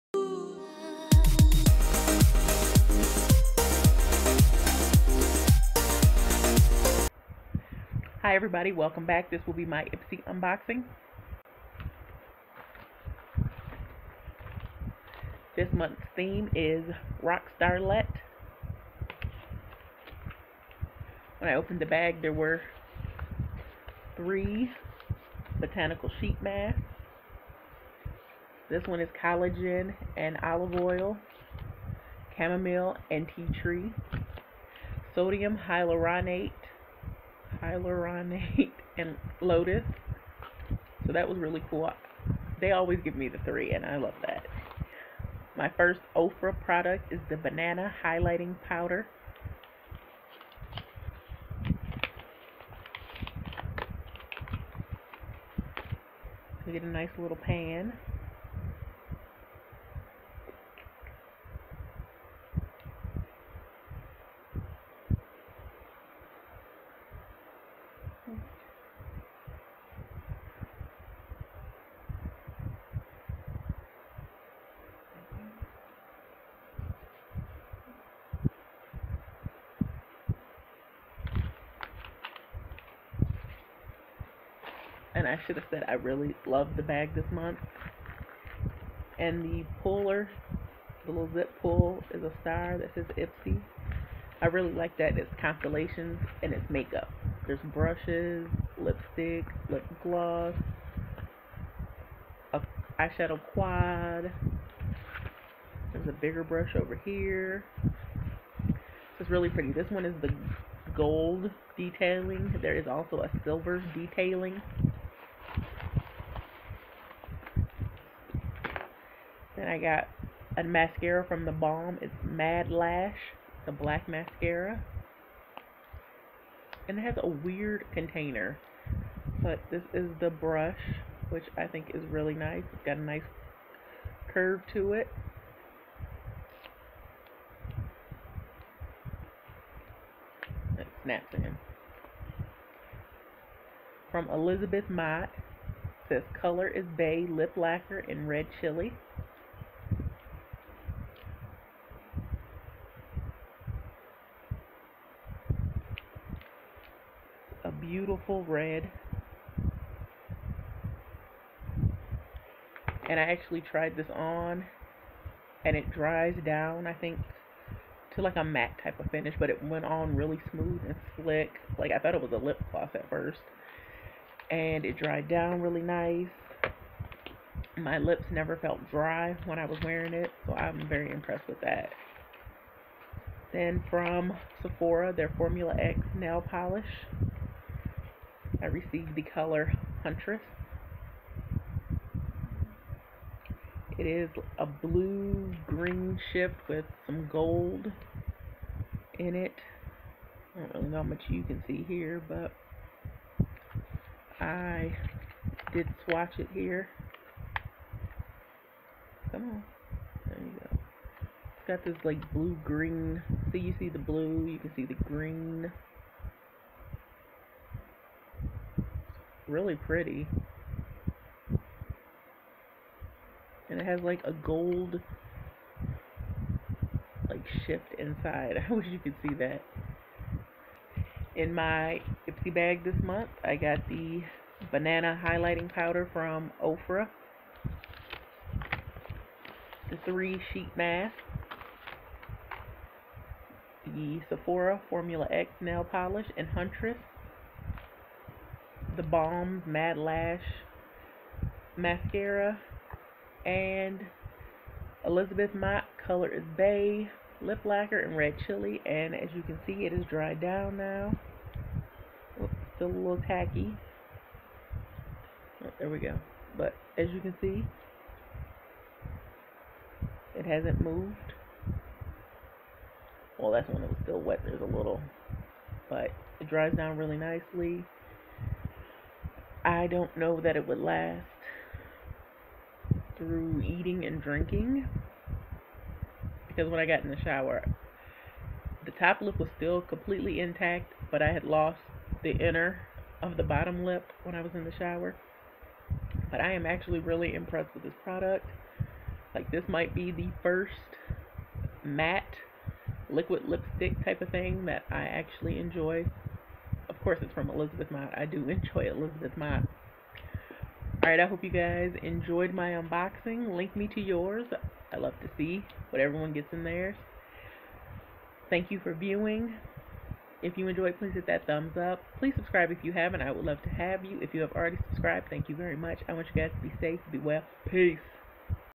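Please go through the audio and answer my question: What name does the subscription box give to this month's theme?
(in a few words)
Rockstarlet.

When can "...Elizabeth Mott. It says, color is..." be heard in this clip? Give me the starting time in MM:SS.
02:24.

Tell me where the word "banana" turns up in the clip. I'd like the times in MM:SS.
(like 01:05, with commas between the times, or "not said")
00:47, 03:54.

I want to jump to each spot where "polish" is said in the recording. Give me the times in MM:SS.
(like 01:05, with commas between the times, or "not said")
03:06, 04:05.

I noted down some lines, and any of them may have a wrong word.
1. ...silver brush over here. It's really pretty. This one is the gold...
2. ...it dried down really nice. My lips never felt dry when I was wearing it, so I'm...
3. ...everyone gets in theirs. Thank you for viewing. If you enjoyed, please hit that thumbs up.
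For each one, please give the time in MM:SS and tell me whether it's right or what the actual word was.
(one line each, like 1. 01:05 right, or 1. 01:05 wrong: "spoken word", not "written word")
1. 01:46 wrong: "bigger", not "silver"
2. 02:54 right
3. 05:16 right.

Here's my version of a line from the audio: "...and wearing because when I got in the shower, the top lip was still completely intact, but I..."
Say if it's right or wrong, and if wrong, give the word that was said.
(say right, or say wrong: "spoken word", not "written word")
wrong: "drinking", not "wearing".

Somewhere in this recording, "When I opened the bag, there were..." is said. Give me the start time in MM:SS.
00:21.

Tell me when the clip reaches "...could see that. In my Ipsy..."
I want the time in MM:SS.
03:48.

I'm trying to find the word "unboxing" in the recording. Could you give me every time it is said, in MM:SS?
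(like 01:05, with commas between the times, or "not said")
00:10, 05:12.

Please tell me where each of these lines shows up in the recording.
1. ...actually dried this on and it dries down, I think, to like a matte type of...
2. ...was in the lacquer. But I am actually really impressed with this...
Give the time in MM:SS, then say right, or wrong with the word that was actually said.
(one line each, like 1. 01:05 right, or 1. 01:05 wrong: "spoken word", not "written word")
1. 02:43 wrong: "tried", not "dried"
2. 04:54 wrong: "shower", not "lacquer".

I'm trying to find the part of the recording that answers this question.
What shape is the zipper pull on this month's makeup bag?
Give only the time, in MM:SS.
01:32.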